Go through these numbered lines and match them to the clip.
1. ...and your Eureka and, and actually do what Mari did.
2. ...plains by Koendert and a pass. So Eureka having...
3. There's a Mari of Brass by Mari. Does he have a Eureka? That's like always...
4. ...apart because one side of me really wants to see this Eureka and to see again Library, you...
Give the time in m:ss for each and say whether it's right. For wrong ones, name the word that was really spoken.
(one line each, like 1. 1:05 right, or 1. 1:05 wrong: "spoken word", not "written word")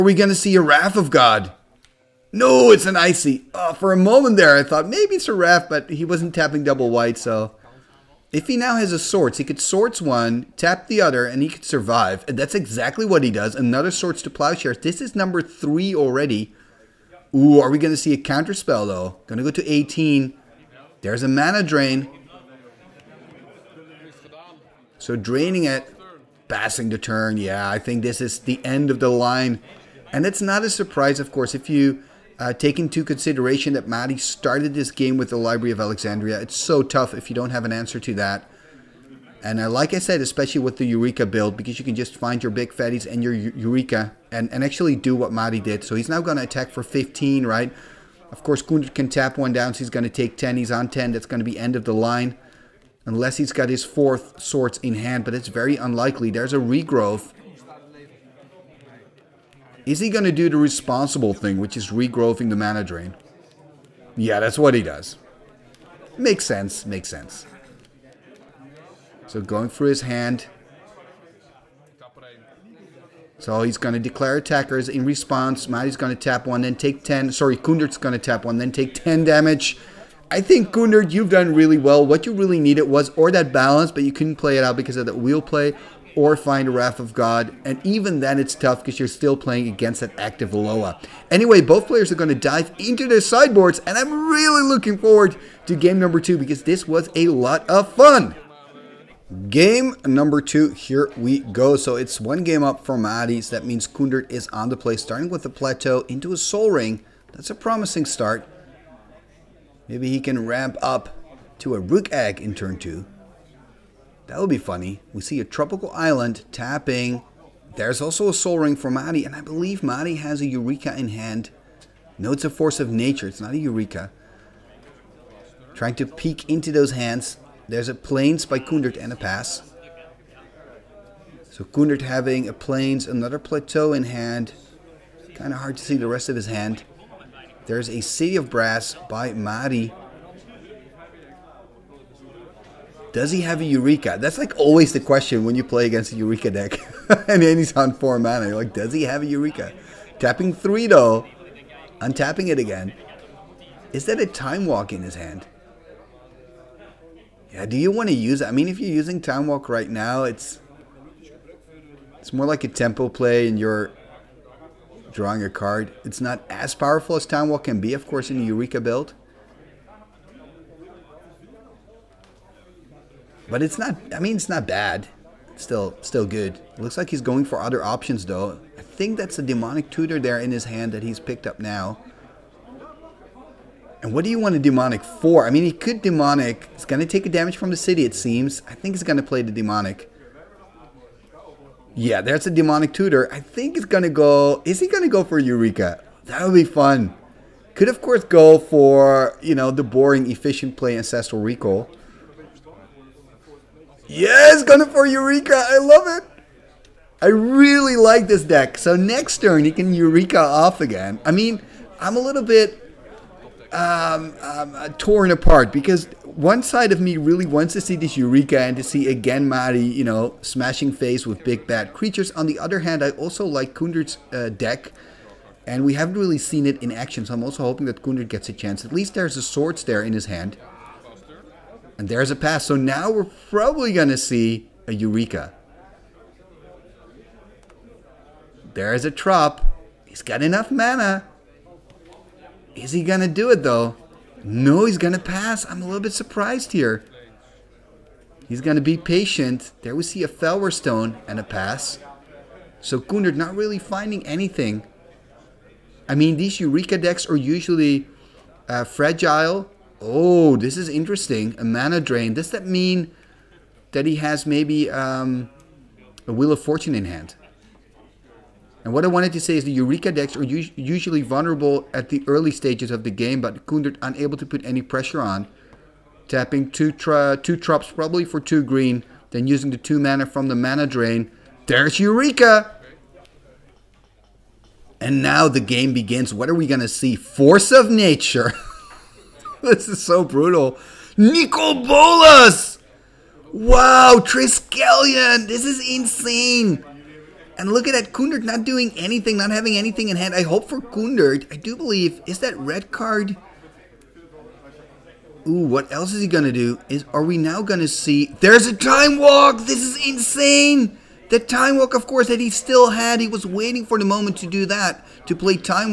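1. 0:43 right
2. 2:07 wrong: "Koendert", not "Eureka"
3. 2:17 wrong: "City", not "Mari"
4. 3:35 wrong: "Mari", not "Library".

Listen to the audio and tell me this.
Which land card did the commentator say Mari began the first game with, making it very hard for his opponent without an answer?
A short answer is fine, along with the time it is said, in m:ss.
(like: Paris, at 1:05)
Library of Alexandria, at 0:35.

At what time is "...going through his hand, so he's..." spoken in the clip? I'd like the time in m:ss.
1:09.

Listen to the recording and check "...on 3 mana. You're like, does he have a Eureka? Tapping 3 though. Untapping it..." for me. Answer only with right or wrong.
wrong.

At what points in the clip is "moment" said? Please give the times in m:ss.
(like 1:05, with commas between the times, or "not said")
0:03, 5:14.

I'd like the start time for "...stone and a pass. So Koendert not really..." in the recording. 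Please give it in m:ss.
4:10.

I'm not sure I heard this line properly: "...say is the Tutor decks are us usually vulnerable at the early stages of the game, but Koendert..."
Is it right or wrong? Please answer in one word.
wrong.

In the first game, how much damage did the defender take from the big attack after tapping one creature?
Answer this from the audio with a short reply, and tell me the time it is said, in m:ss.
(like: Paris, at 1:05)
10, at 0:49.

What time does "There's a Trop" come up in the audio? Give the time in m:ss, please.
3:58.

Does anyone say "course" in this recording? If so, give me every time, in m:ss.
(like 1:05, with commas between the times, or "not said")
0:31, 0:48, 2:48, 3:18, 5:12.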